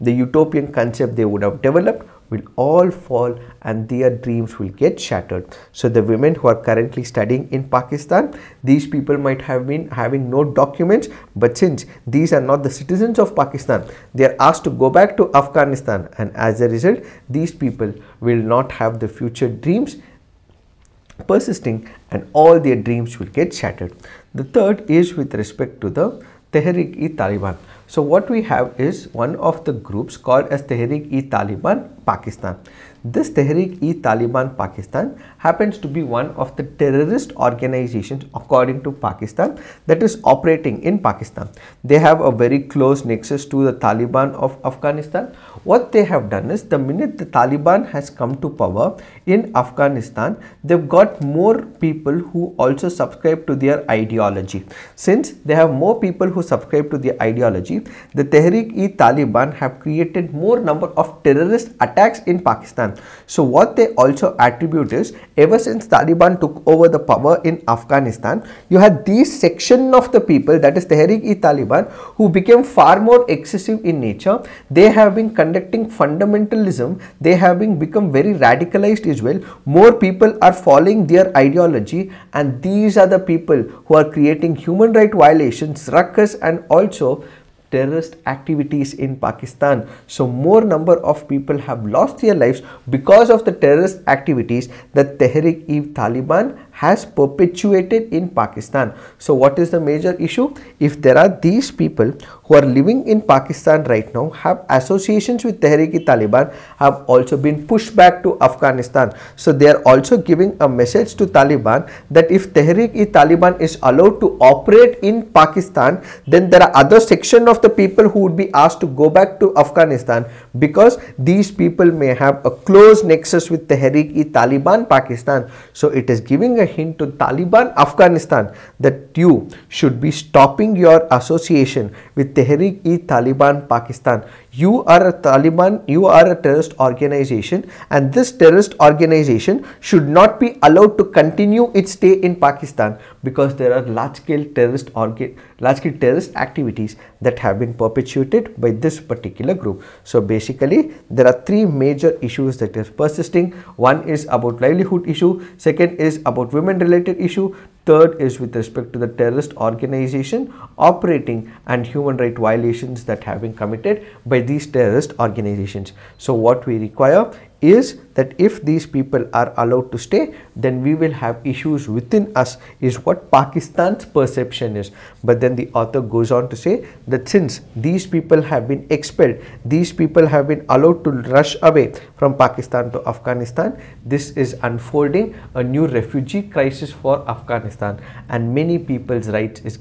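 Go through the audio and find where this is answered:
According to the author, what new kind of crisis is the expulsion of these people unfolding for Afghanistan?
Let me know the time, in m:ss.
3:05.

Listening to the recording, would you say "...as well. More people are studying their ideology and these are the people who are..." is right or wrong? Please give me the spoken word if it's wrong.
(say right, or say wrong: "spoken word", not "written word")
wrong: "following", not "studying".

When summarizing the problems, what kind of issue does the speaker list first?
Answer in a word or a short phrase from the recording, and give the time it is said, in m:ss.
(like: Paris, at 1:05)
Livelihood issue, at 2:34.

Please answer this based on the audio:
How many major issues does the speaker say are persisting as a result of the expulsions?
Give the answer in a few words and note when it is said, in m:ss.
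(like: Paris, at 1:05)
3, at 2:31.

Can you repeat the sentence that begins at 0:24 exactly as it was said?
The third is with respect to the Tehreek-e-Taliban.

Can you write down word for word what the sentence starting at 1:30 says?
So more number of people have lost their lives because of the terrorist activities that Tehrik-e-Taliban has perpetuated in Pakistan.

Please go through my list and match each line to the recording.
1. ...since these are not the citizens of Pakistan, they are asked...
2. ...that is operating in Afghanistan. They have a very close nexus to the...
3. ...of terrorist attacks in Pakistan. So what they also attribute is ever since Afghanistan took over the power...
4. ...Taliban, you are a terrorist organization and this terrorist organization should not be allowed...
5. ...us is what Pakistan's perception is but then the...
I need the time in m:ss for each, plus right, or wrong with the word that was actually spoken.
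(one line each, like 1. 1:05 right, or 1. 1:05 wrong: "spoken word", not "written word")
1. 0:11 right
2. 0:39 wrong: "Pakistan", not "Afghanistan"
3. 1:00 wrong: "Taliban", not "Afghanistan"
4. 2:15 right
5. 2:52 right.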